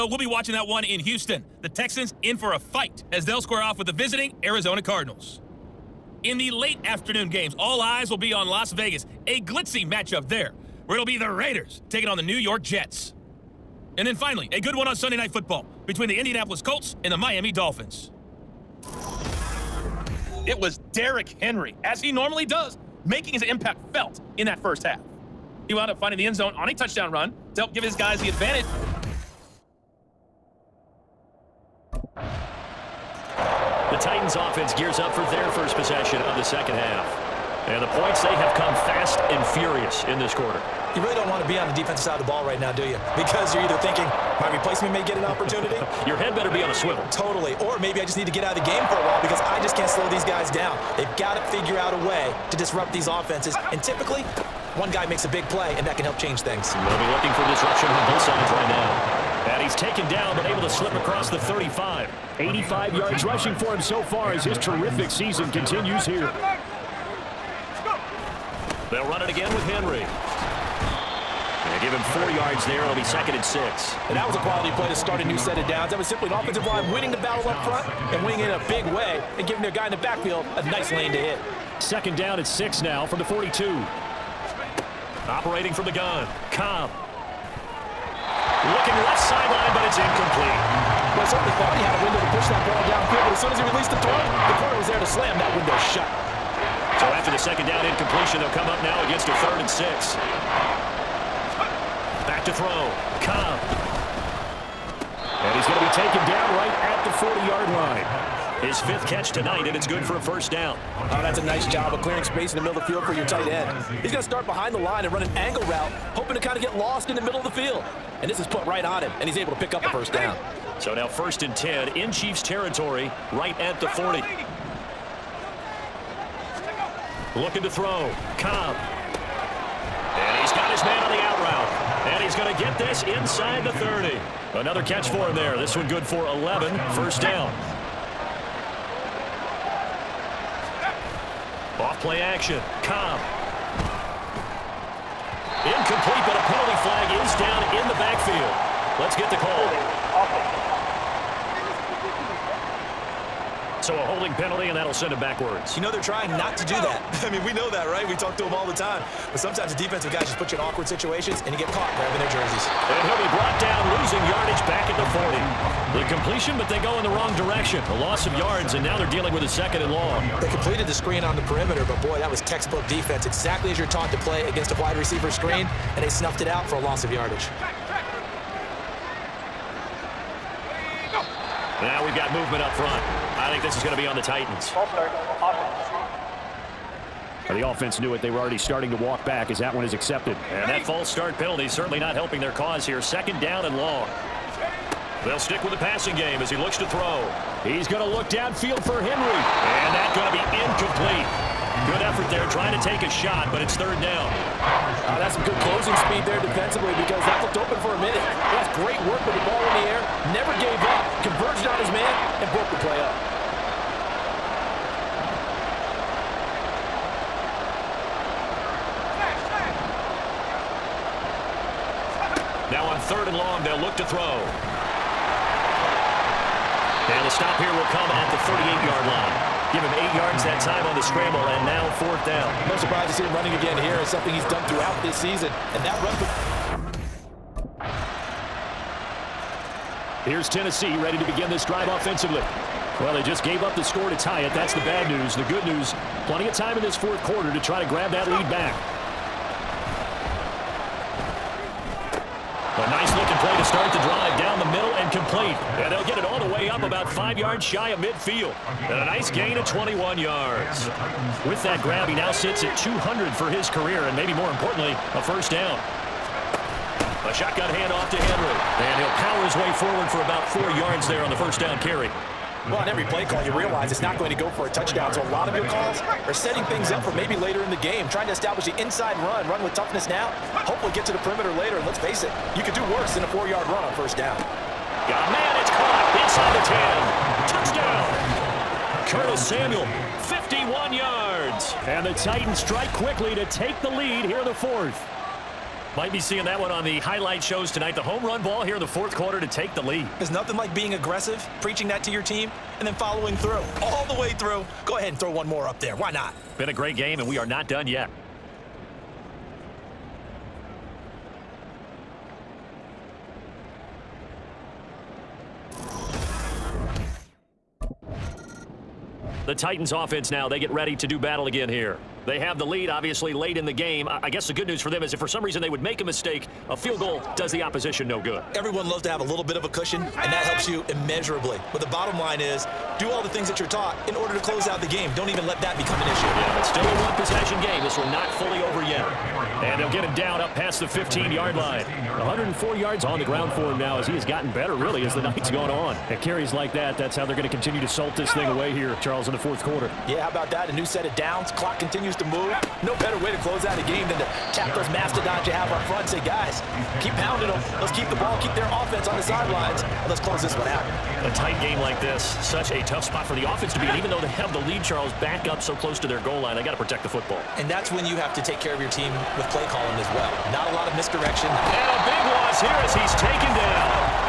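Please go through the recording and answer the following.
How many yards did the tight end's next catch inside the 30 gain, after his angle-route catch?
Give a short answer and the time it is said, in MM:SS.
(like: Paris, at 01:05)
11, at 02:15.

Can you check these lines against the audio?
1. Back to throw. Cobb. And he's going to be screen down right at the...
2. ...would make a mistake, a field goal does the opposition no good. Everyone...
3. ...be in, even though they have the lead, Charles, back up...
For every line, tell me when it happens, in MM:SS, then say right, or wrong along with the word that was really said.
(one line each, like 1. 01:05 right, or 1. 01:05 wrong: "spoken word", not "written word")
1. 01:42 wrong: "taken", not "screen"
2. 05:25 right
3. 06:03 right.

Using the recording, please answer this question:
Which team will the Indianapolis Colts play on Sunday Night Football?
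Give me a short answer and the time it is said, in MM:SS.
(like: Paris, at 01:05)
Miami Dolphins, at 00:17.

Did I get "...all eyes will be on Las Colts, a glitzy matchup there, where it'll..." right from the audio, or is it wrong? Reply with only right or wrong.
wrong.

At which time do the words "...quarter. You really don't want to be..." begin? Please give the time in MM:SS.
00:40.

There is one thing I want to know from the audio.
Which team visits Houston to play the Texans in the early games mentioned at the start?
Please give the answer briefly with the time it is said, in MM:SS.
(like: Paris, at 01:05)
Arizona Cardinals, at 00:04.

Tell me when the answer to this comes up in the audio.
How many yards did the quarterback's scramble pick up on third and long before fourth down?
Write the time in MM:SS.
03:49.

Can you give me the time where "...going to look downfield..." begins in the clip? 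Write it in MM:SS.
03:17.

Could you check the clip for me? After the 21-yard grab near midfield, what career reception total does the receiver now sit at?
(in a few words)
200.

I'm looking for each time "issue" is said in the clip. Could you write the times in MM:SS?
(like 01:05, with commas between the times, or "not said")
05:36.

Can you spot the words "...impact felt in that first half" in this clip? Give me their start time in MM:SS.
00:23.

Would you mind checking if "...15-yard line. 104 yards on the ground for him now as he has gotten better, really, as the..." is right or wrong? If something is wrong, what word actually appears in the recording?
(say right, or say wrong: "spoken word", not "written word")
right.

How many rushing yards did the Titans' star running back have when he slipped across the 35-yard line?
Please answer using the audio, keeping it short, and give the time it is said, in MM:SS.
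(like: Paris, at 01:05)
85, at 01:02.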